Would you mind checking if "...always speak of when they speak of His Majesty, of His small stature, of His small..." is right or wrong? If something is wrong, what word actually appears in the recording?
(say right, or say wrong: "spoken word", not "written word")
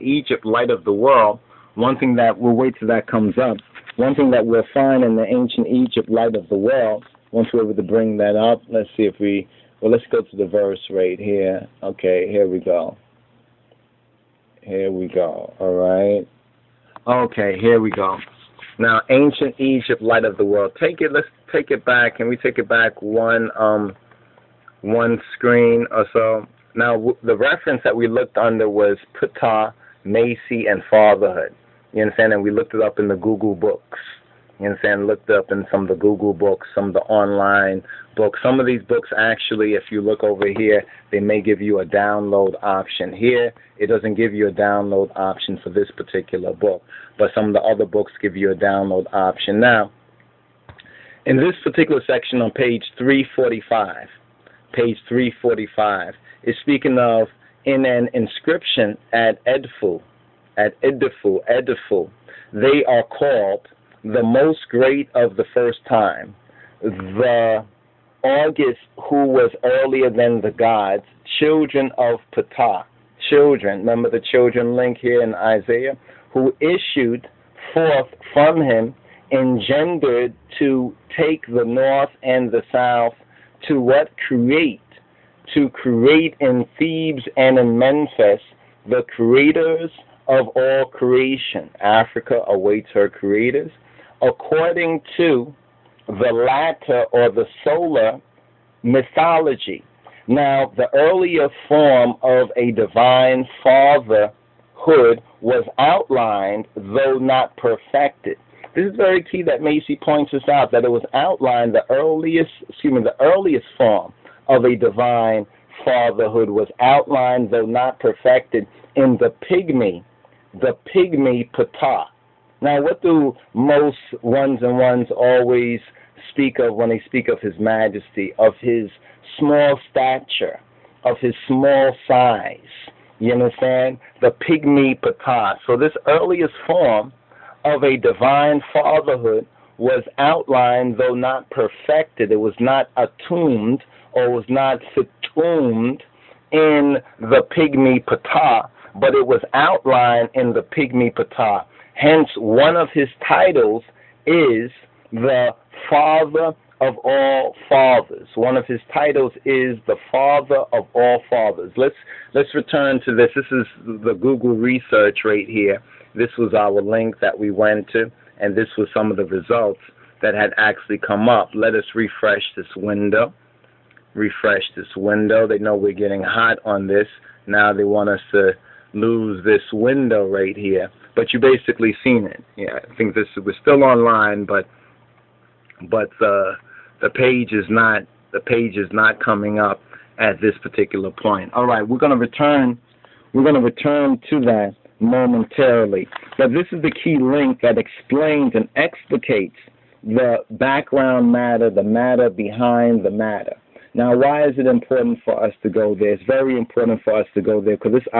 right.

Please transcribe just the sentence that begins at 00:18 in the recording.
Now, ancient Egypt, light of the world.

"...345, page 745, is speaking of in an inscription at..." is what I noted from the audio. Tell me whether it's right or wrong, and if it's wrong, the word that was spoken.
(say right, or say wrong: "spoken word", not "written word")
wrong: "345", not "745".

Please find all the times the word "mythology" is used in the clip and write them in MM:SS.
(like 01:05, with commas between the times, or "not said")
01:38.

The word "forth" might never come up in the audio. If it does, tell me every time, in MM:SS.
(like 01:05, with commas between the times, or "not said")
01:17.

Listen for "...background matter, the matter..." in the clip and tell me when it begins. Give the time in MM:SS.
03:20.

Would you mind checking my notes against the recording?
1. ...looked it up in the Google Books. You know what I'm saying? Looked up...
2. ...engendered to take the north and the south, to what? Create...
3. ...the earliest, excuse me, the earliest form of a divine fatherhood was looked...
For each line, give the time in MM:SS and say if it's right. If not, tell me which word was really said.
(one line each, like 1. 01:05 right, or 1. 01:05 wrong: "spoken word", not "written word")
1. 00:32 right
2. 01:19 right
3. 01:51 wrong: "outlined", not "looked".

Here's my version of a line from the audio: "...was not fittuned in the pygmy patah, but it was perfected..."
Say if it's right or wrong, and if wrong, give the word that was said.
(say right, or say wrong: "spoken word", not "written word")
wrong: "outlined", not "perfected".